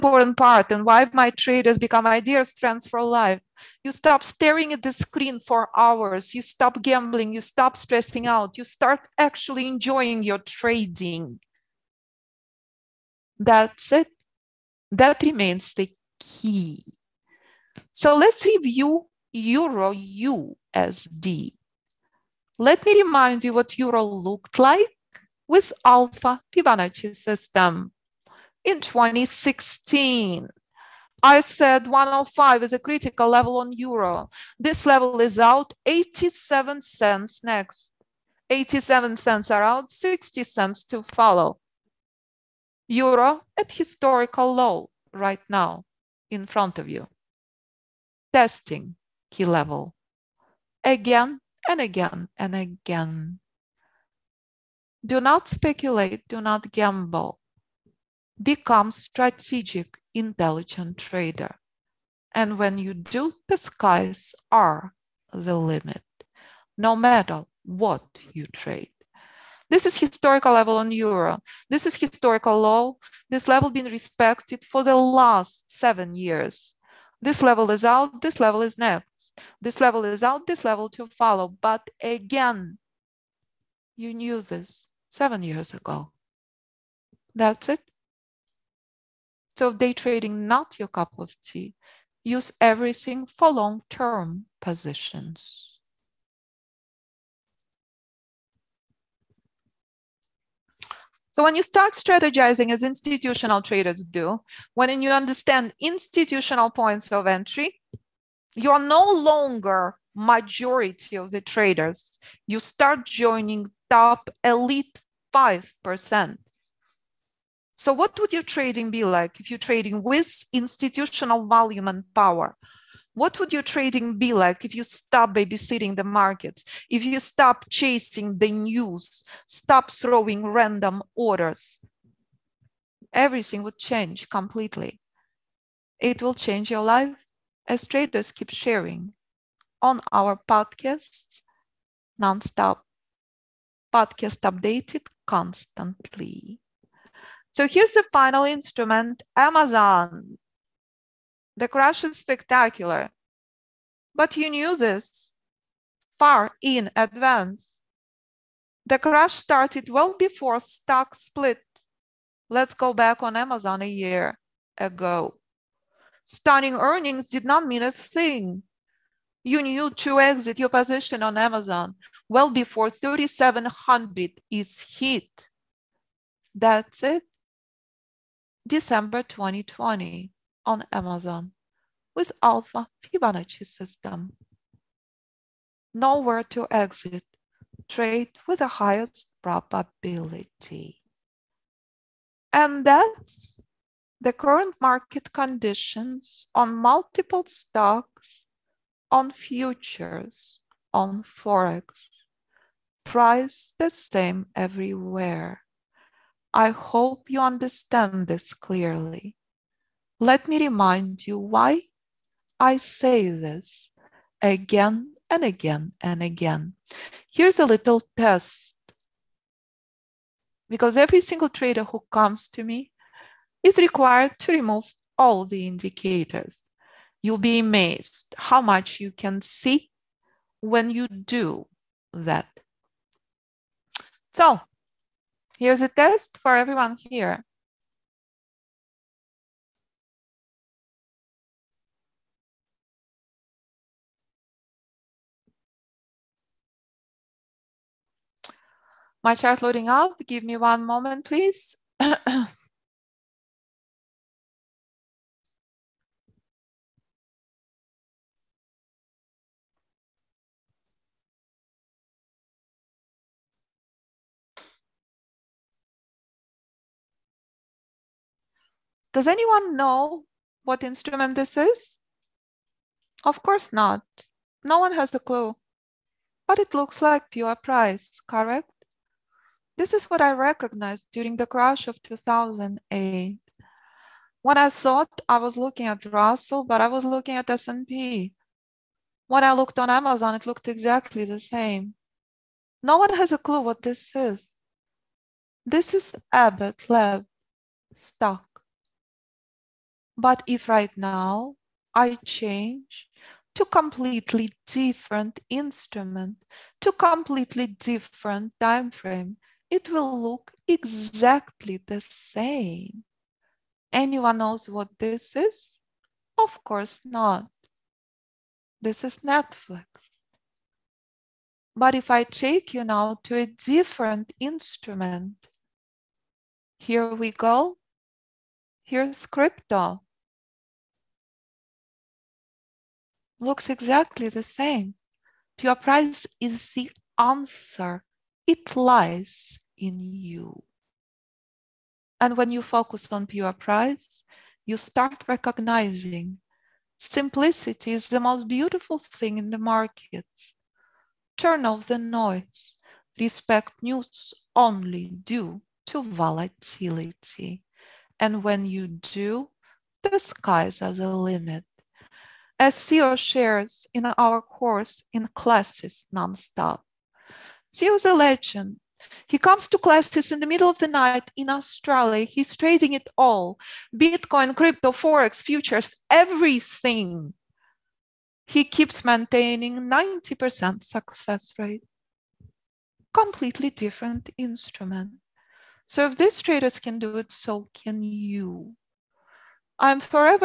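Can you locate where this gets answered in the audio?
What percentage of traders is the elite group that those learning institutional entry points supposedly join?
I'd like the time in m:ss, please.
1:55.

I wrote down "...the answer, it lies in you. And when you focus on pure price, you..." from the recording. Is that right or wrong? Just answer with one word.
right.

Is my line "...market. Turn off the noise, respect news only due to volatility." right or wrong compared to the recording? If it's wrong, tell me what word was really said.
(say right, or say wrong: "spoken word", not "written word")
right.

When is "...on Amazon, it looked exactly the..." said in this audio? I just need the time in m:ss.
4:49.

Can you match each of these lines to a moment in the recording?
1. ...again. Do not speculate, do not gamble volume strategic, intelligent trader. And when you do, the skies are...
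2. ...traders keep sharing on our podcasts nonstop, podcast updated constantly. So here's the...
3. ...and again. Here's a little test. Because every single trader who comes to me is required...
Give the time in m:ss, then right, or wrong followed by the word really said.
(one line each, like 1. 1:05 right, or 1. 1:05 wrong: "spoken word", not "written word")
1. 0:52 wrong: "become", not "volume"
2. 2:17 right
3. 3:35 right.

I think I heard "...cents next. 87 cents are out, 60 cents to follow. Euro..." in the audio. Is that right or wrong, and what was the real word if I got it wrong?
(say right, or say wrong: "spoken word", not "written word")
right.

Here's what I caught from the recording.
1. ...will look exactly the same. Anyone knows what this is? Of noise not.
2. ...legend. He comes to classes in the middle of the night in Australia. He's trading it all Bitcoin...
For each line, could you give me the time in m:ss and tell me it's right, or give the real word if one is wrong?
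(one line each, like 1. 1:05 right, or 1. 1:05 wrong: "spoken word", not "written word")
1. 5:09 wrong: "course", not "noise"
2. 6:08 right.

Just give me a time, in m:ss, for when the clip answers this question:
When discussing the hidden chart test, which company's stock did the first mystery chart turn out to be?
4:56.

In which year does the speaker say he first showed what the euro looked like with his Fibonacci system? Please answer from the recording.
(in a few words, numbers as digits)
2016.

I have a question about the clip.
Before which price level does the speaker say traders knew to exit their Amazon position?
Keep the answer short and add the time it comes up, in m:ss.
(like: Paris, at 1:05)
3,700, at 2:52.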